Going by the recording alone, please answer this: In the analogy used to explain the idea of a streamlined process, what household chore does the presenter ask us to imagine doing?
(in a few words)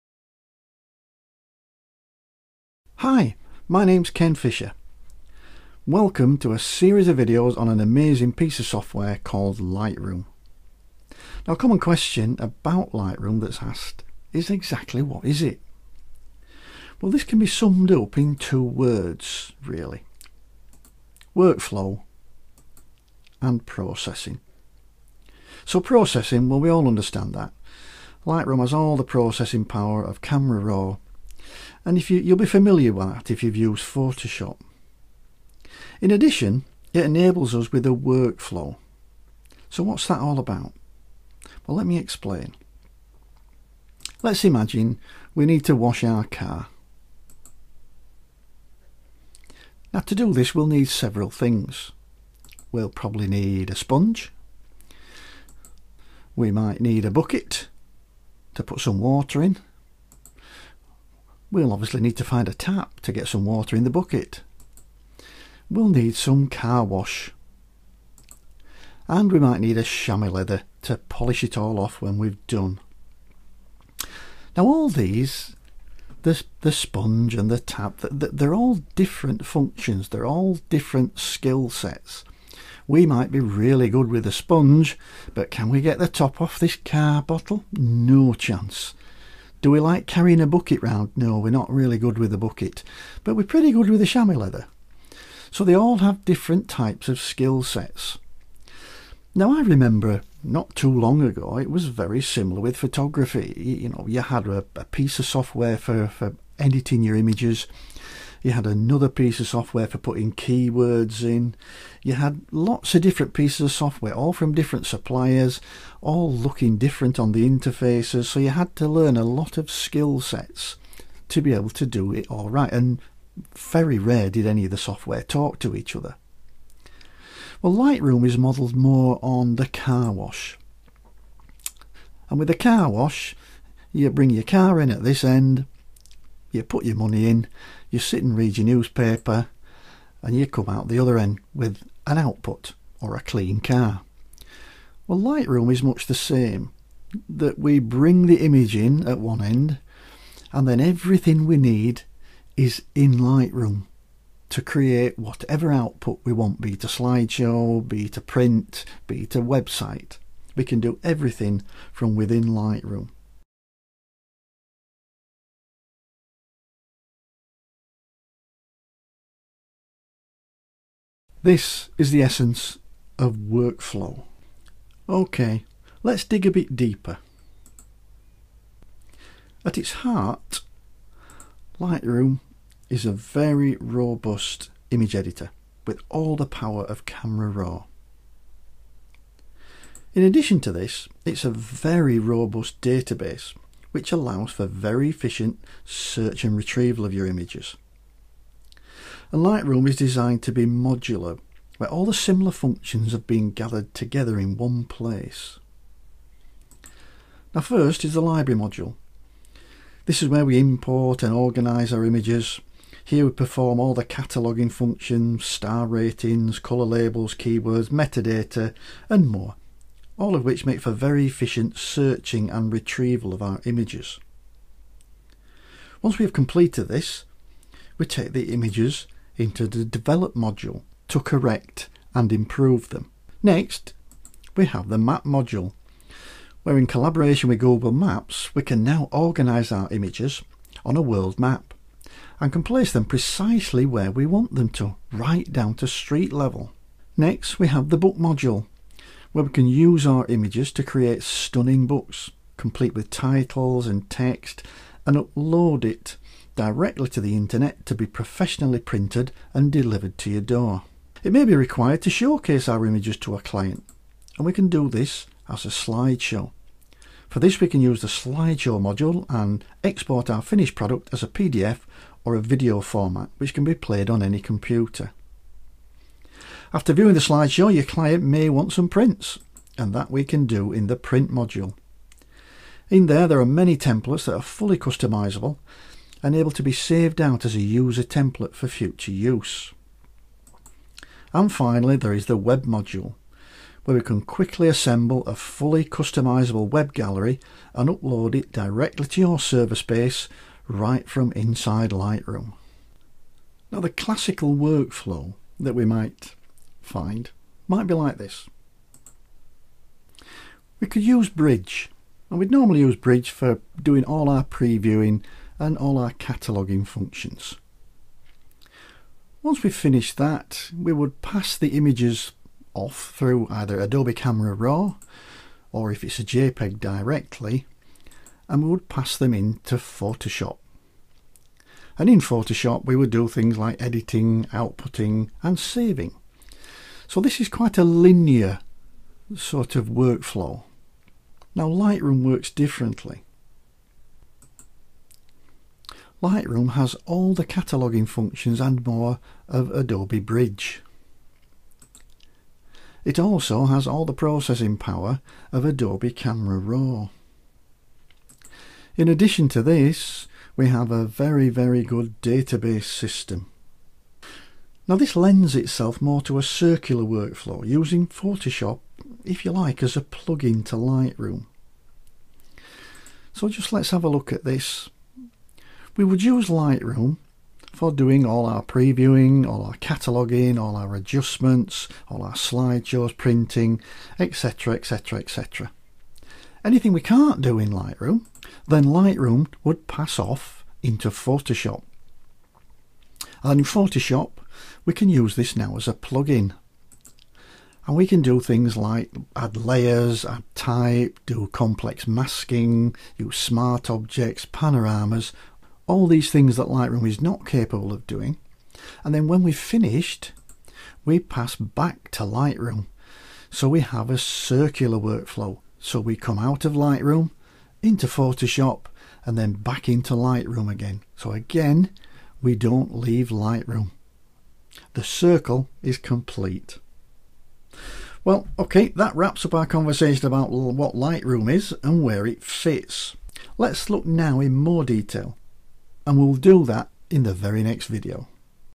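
Wash our car.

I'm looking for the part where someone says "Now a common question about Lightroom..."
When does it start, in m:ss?
0:11.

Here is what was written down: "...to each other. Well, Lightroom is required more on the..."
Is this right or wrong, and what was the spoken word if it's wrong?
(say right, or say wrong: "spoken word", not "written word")
wrong: "modelled", not "required".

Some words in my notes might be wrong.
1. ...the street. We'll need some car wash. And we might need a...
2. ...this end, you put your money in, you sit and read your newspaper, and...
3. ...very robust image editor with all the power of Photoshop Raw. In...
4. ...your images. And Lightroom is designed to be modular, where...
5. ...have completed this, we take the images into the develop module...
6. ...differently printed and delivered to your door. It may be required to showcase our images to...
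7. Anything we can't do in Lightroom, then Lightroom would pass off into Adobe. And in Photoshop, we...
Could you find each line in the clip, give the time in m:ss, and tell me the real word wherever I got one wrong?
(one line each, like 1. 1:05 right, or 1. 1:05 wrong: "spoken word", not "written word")
1. 1:03 wrong: "bucket", not "street"
2. 2:15 right
3. 3:03 wrong: "Camera", not "Photoshop"
4. 3:17 right
5. 3:46 right
6. 4:18 wrong: "professionally", not "differently"
7. 6:26 wrong: "Photoshop", not "Adobe".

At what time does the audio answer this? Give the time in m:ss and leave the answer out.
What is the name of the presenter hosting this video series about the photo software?
0:04.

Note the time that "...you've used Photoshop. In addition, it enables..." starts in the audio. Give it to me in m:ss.
0:33.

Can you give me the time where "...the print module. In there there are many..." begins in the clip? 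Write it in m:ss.
4:40.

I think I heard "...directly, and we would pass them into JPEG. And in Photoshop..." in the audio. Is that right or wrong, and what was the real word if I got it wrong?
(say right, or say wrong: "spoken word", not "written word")
wrong: "Photoshop", not "JPEG".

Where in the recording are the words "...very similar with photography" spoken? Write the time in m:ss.
1:41.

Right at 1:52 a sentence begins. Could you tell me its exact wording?
You had lots of different pieces of software, all from different suppliers, all looking different on the interfaces.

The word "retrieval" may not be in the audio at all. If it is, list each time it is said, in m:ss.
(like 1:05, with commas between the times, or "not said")
3:16, 3:42.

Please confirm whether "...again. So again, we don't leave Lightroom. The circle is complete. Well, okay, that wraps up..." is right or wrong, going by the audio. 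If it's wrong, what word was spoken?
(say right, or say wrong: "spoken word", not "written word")
right.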